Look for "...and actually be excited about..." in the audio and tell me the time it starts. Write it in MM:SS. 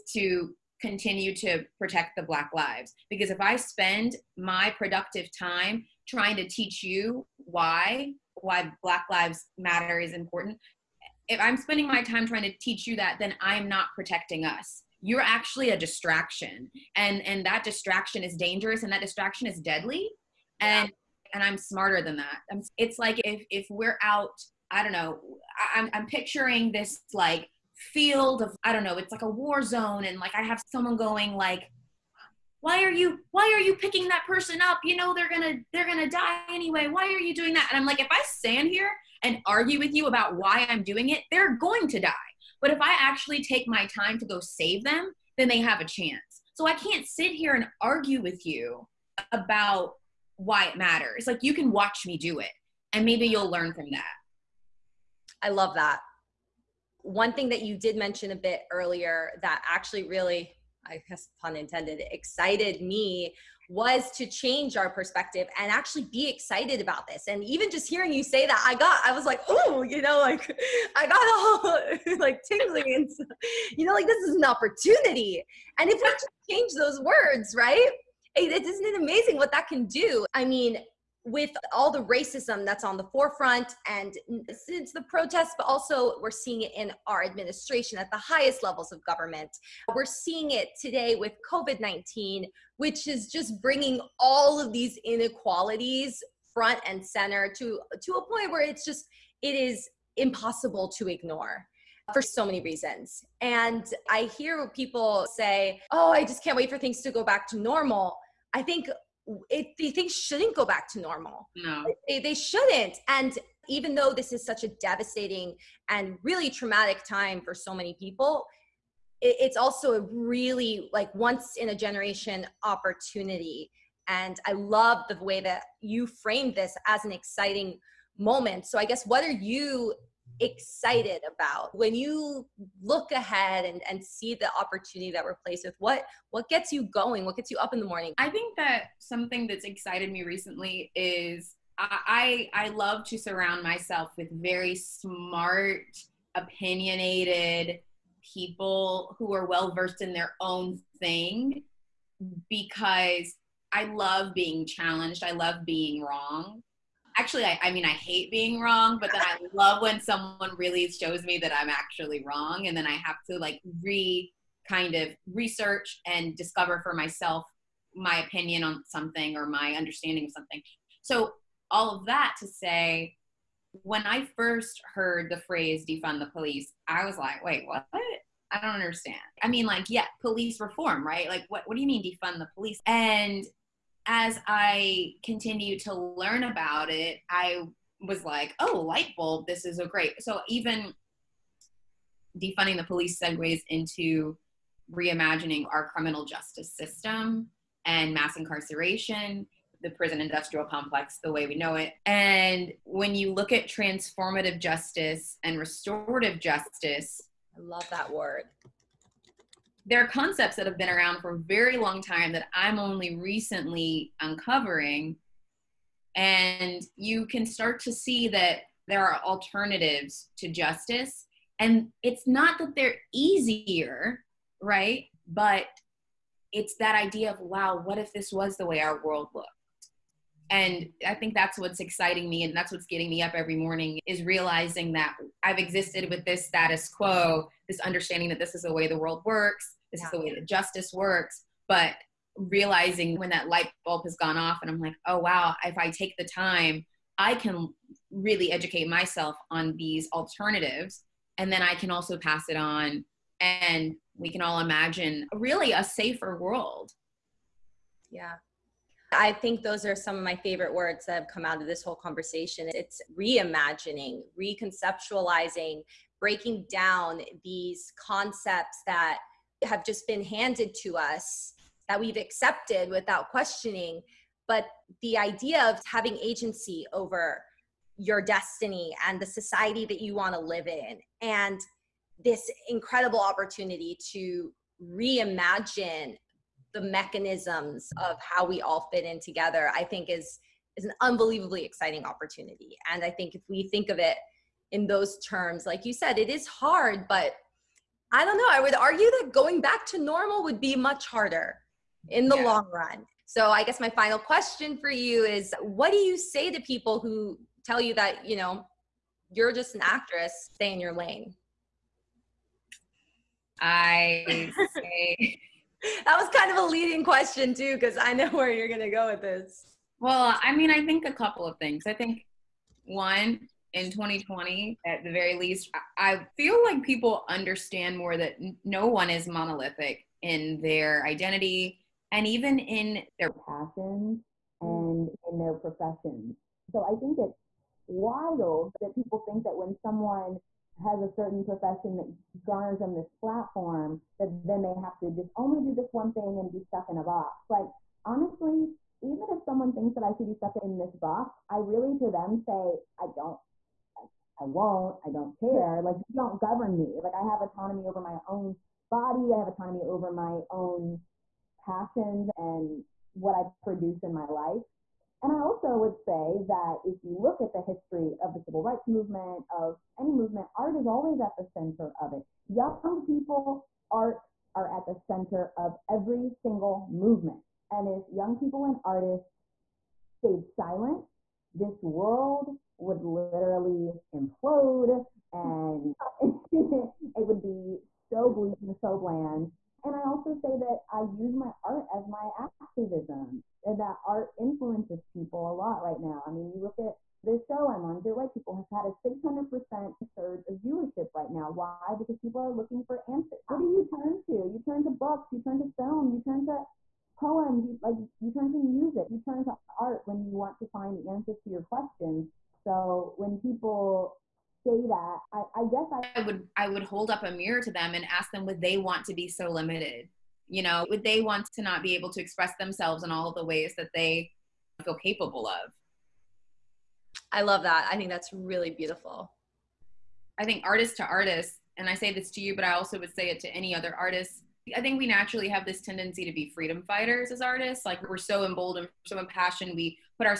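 01:05.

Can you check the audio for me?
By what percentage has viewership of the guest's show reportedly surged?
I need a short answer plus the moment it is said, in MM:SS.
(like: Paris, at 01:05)
600%, at 06:39.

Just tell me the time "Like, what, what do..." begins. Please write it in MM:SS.
03:01.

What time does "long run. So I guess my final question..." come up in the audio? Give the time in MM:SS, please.
05:02.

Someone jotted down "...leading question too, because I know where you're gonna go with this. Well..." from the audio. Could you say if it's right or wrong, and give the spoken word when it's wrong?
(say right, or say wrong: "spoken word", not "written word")
right.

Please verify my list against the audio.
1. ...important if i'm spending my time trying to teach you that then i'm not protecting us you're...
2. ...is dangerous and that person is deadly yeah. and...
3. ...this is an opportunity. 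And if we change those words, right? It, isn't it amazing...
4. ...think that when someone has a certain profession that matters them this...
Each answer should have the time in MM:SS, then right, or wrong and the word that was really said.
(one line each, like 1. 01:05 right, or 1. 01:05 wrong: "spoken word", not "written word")
1. 00:10 right
2. 00:18 wrong: "distraction", not "person"
3. 01:14 right
4. 05:39 wrong: "garners", not "matters".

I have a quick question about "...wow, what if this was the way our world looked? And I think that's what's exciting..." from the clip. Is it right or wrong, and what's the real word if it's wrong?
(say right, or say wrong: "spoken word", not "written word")
right.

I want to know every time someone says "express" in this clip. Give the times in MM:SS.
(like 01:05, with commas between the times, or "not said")
07:02.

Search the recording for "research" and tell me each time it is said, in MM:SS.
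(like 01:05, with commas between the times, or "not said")
02:45.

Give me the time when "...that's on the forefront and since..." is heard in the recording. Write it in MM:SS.
01:22.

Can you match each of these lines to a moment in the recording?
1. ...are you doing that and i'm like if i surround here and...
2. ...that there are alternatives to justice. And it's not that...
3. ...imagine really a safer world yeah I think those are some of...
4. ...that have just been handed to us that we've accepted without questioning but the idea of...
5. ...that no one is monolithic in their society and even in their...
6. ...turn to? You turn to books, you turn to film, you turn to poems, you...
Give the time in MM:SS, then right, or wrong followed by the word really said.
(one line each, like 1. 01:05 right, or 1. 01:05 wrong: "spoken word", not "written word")
1. 00:37 wrong: "stand", not "surround"
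2. 03:38 right
3. 04:14 right
4. 04:28 right
5. 05:28 wrong: "identity", not "society"
6. 06:43 right.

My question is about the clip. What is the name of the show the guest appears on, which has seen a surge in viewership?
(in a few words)
Dear White People.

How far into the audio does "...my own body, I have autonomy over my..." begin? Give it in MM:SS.
05:58.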